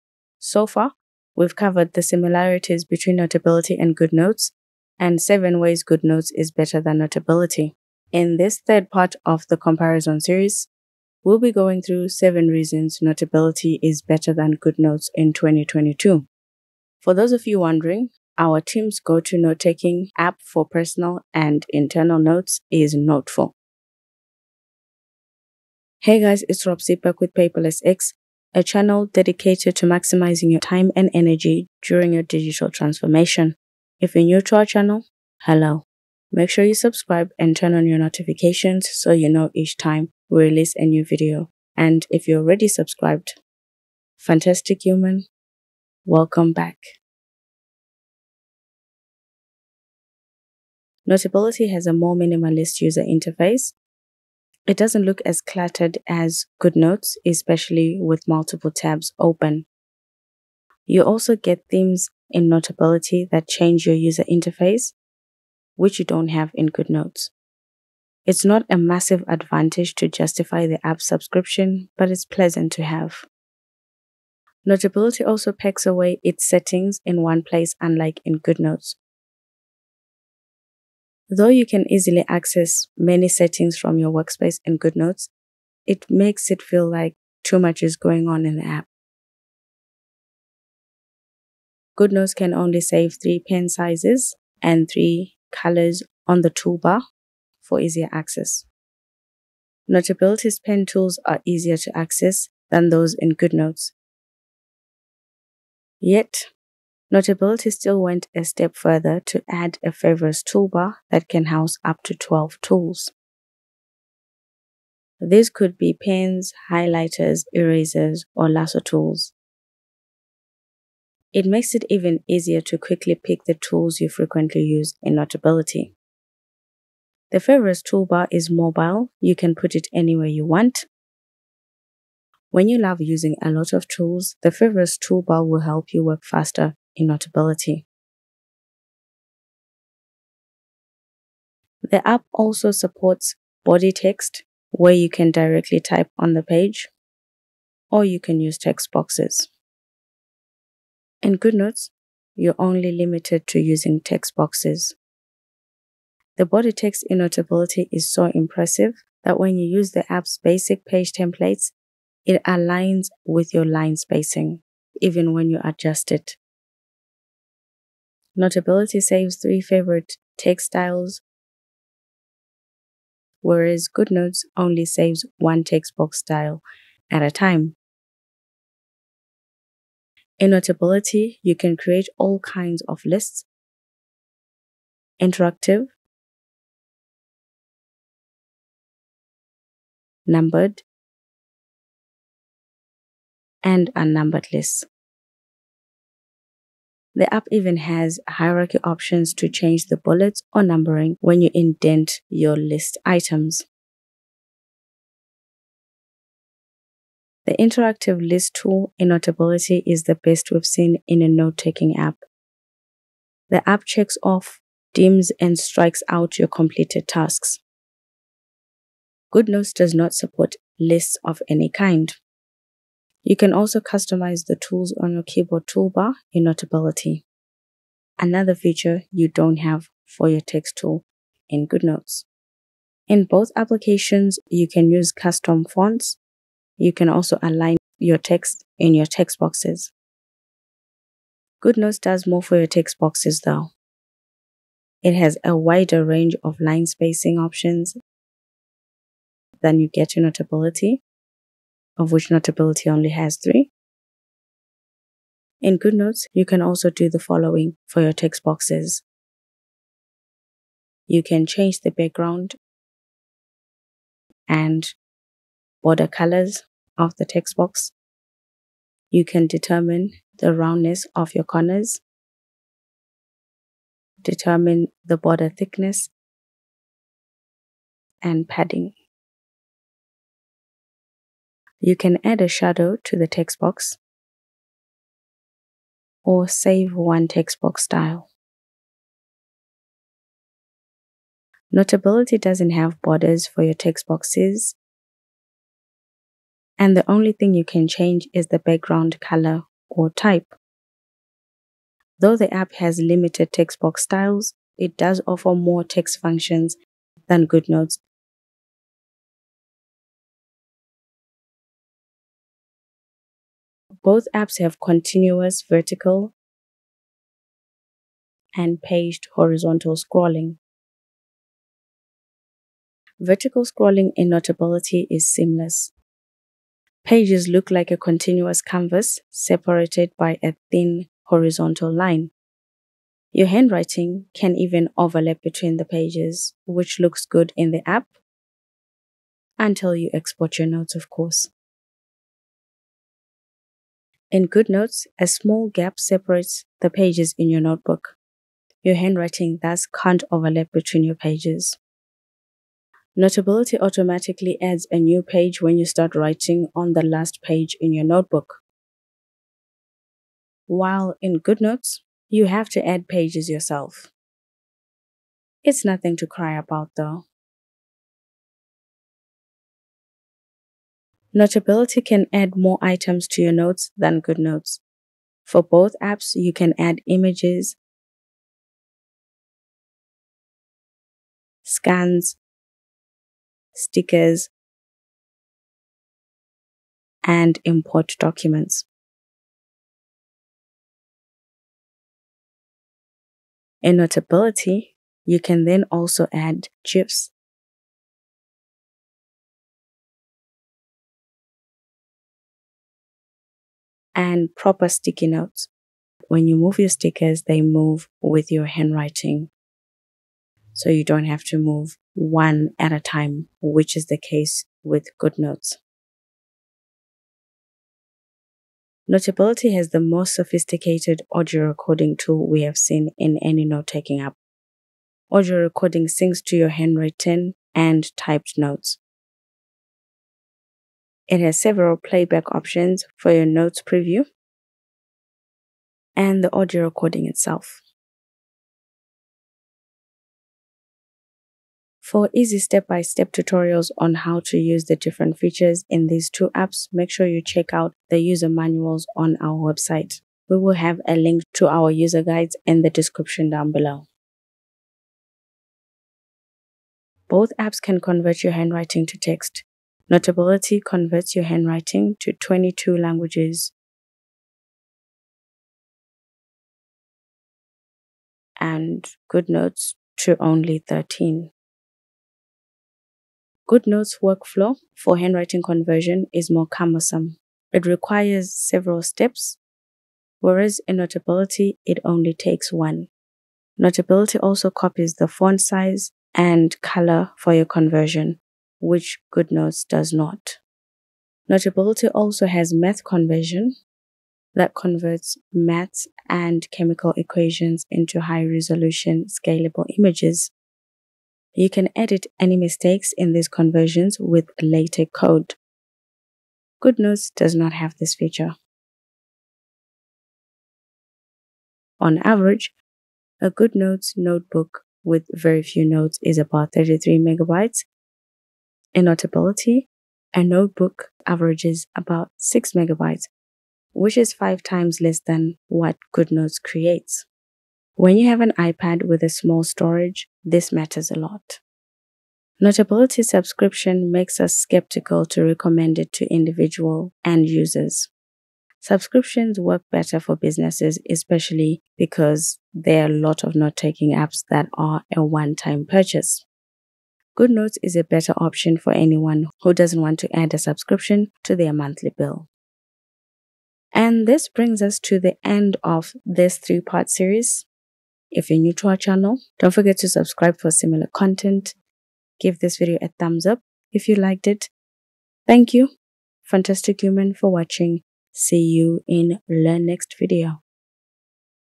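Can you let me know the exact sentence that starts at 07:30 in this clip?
We will have a link to our user guides in the description down below.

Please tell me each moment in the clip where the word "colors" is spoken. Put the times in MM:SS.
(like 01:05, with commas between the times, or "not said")
01:35, 04:26, 04:59, 08:06.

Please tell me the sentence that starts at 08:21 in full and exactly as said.
You can edit any mistakes in these conversions with LaTeX code.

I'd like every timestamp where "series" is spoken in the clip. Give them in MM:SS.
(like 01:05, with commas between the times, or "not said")
00:10, 09:17.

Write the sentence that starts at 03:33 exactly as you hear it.
The app checks off, dims, and strikes out your completed tasks.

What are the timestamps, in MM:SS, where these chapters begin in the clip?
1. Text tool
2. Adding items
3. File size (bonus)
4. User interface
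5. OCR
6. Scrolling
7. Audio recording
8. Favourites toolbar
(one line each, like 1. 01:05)
1. 02:18
2. 06:08
3. 08:29
4. 00:48
5. 07:35
6. 05:11
7. 06:56
8. 01:29.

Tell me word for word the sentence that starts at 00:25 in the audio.
Hey guys, it's Rob Sipek with Paperless X a channel dedicated to maximizing your time and energy during your digital transformation.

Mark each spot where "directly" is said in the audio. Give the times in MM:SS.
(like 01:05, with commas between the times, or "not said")
02:25.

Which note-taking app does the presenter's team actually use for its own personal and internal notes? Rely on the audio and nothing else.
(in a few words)
Noteful.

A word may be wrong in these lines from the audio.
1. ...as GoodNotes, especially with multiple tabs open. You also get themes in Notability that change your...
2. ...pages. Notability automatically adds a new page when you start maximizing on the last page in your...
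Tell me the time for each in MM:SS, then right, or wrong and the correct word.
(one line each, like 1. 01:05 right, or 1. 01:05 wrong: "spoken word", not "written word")
1. 00:56 right
2. 05:51 wrong: "writing", not "maximizing".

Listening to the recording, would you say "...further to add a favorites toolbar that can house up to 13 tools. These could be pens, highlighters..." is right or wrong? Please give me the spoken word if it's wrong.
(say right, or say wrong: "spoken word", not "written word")
wrong: "12", not "13".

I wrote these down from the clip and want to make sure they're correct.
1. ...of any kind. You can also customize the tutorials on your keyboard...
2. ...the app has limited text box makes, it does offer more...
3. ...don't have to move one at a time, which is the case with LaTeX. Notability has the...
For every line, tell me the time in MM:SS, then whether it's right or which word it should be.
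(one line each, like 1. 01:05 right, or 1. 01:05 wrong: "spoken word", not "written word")
1. 03:41 wrong: "tools", not "tutorials"
2. 05:02 wrong: "styles", not "makes"
3. 06:51 wrong: "GoodNotes", not "LaTeX".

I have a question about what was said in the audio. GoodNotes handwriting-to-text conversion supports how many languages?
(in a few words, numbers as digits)
13.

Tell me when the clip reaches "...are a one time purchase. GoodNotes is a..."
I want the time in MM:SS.
09:04.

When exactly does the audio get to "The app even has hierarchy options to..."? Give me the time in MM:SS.
03:17.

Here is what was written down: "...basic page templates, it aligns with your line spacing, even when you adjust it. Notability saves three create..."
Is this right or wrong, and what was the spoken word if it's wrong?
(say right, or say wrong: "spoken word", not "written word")
wrong: "favorite", not "create".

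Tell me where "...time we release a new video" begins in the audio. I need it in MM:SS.
00:39.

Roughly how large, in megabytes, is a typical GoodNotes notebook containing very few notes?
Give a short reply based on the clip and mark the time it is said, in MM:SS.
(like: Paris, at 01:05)
33 megabytes, at 08:36.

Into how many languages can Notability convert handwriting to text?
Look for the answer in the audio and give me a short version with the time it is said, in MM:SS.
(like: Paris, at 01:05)
22, at 07:42.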